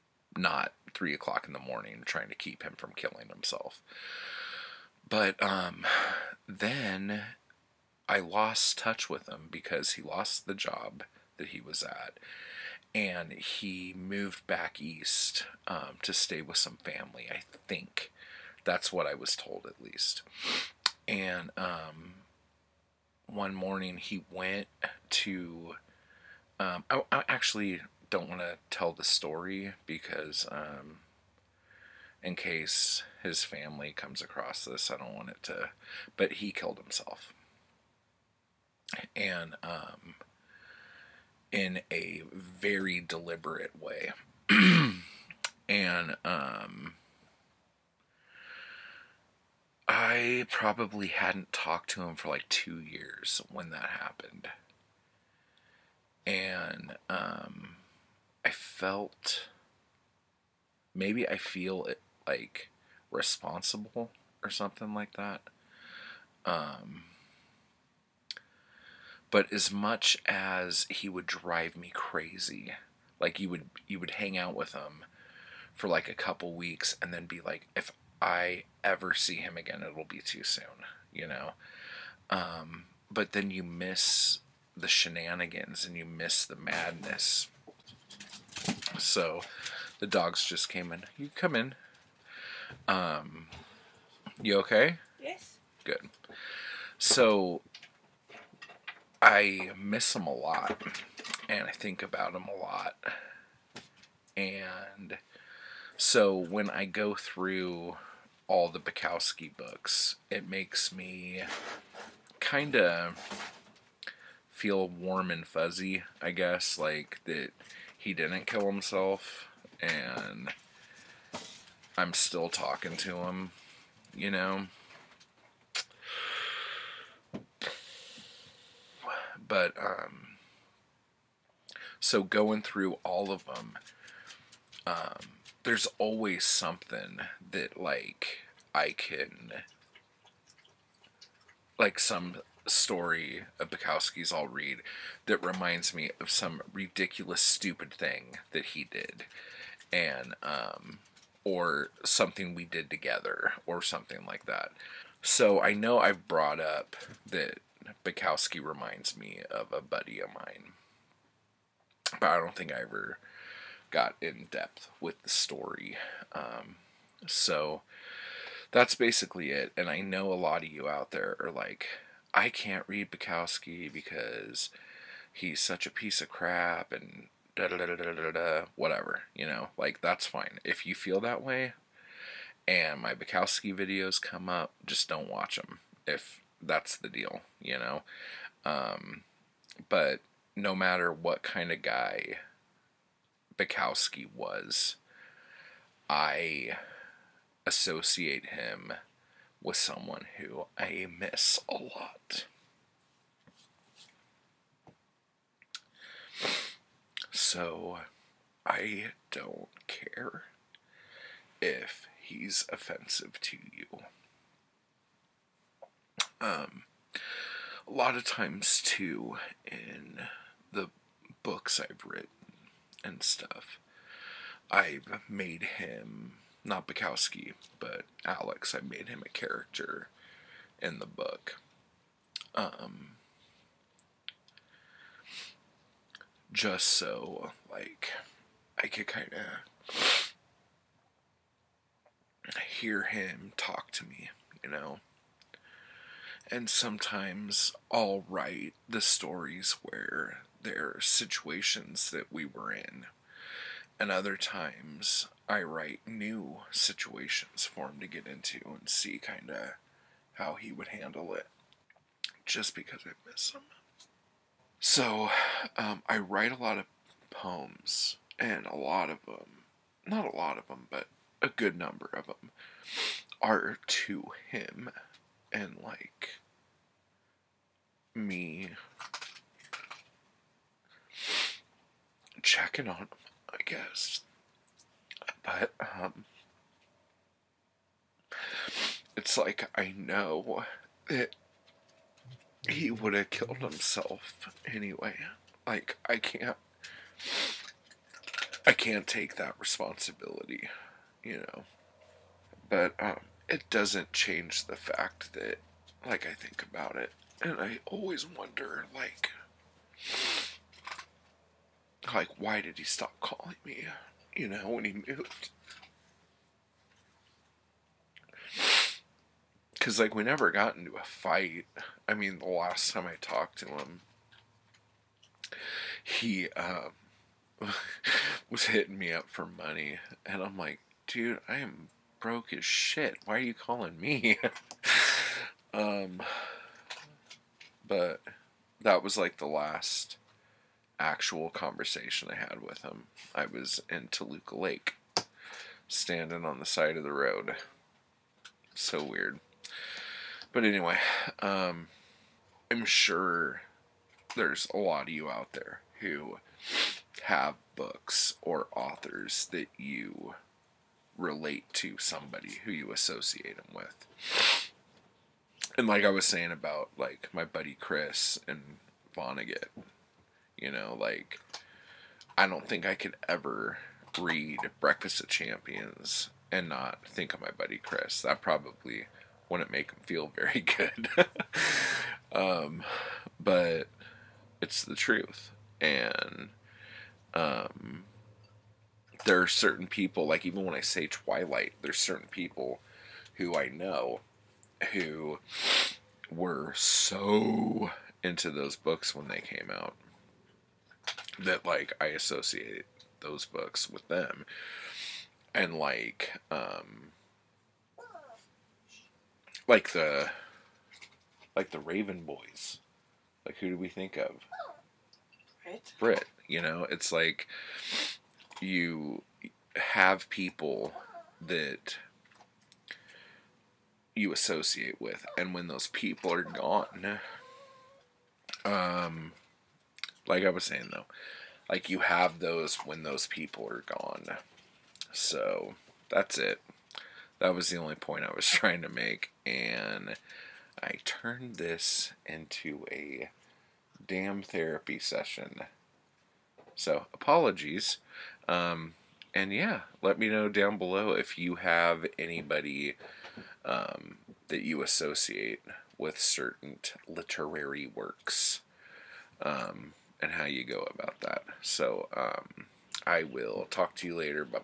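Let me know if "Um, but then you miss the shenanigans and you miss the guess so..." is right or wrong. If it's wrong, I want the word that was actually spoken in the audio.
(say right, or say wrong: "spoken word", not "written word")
wrong: "madness", not "guess".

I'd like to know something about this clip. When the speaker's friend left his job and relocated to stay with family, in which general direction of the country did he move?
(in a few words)
Back east.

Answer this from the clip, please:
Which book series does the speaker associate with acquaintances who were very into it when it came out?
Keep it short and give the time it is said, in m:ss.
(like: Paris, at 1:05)
Twilight, at 6:31.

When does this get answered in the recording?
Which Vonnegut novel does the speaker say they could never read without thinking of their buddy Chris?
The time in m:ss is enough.
6:14.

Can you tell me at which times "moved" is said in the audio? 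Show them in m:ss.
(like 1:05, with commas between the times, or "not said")
0:13, 5:14.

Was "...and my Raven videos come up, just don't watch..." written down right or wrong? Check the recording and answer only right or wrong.
wrong.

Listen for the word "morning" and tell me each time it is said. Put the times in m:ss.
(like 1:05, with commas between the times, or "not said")
0:01, 0:23.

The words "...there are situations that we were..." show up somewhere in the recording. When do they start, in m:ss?
4:10.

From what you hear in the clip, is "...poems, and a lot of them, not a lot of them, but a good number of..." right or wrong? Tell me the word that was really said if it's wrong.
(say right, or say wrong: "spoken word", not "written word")
right.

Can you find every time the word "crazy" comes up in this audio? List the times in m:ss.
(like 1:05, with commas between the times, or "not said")
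1:11.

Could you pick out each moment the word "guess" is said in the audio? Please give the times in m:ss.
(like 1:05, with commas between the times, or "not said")
1:56, 4:43.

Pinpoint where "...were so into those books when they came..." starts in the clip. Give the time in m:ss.
6:36.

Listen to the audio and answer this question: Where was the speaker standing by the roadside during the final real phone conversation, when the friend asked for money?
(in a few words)
Toluca Lake.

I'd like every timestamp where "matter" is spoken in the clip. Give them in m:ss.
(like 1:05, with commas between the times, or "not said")
3:10.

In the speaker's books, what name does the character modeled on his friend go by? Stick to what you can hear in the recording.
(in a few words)
Alex.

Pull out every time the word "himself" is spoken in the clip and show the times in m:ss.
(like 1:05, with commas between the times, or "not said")
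0:03, 0:36, 1:58, 4:53.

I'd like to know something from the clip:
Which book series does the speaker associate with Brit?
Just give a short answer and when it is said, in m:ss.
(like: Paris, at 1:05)
The Raven Boys, at 6:51.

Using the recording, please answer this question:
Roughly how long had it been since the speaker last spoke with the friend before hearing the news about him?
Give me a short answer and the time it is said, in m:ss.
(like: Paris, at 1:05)
2 years, at 0:52.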